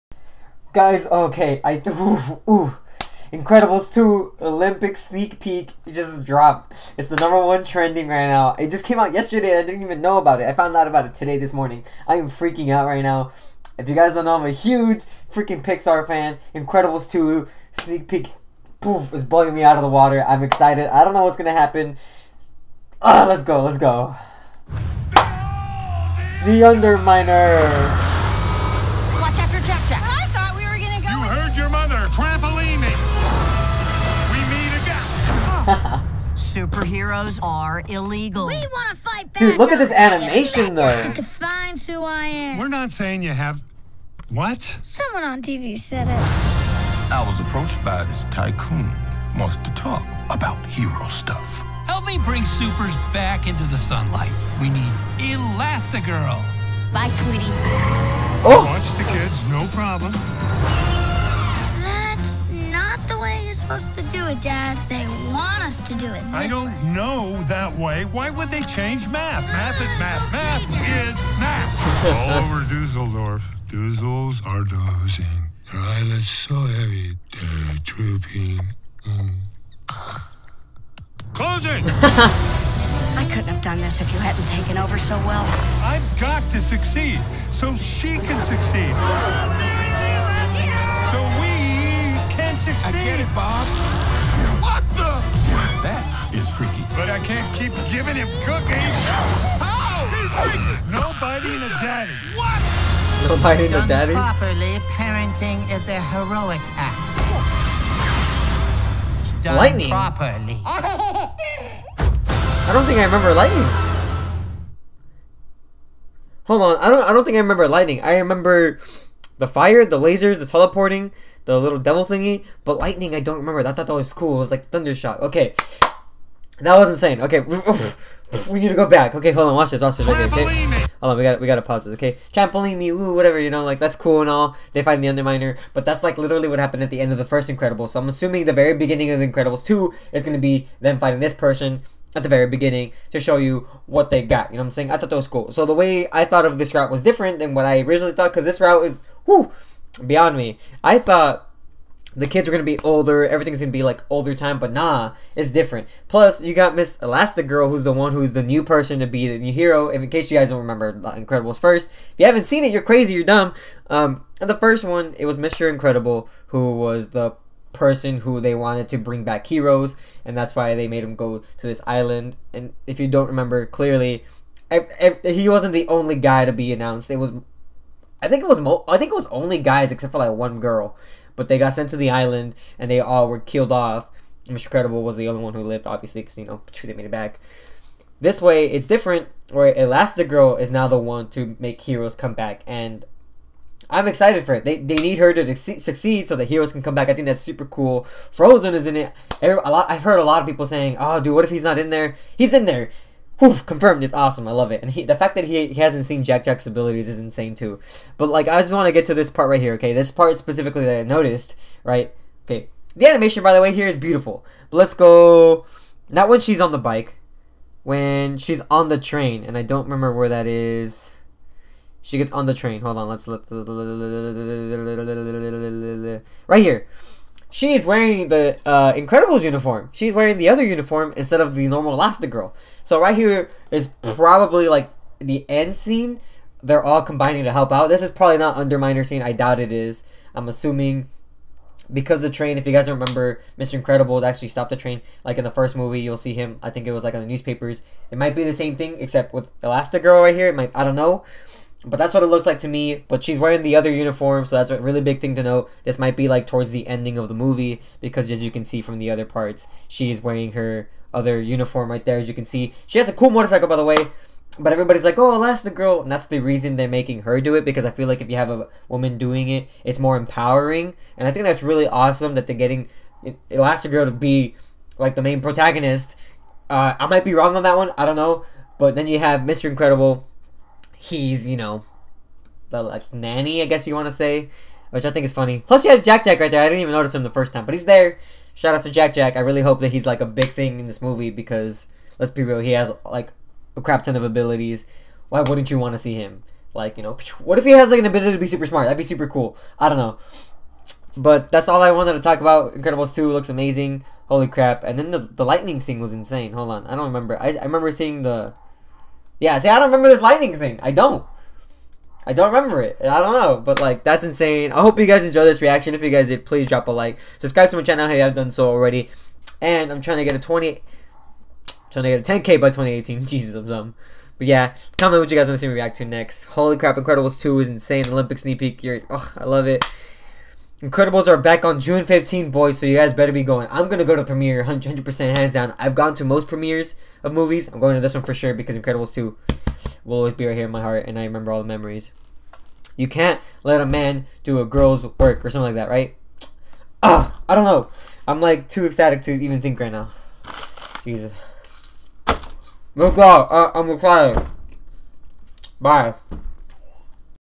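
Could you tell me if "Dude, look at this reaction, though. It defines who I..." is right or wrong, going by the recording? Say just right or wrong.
wrong.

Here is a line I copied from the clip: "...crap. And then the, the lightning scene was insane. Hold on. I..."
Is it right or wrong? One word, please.
right.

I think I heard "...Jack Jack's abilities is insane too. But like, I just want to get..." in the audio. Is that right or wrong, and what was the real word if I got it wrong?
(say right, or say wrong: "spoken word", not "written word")
right.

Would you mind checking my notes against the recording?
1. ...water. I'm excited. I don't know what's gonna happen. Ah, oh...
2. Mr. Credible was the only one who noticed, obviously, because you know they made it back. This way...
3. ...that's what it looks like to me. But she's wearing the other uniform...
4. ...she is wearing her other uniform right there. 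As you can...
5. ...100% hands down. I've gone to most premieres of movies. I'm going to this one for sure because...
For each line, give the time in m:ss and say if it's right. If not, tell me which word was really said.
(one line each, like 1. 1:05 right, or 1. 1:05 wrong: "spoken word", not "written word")
1. 0:19 right
2. 3:04 wrong: "lived", not "noticed"
3. 4:11 right
4. 4:19 right
5. 5:34 right.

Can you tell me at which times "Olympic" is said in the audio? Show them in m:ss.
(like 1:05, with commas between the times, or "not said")
0:04, 5:28.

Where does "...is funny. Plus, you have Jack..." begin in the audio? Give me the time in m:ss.
4:45.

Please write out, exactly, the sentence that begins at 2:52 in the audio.
And if you don't remember clearly, I, I, he wasn't the only guy to be announced.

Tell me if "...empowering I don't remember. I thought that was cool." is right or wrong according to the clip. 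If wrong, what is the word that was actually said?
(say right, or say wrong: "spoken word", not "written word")
wrong: "lightning", not "empowering".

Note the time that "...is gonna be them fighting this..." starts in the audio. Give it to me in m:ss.
2:20.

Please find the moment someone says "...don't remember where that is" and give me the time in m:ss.
3:39.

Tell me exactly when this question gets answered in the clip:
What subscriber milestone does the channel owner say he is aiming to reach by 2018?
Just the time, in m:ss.
5:22.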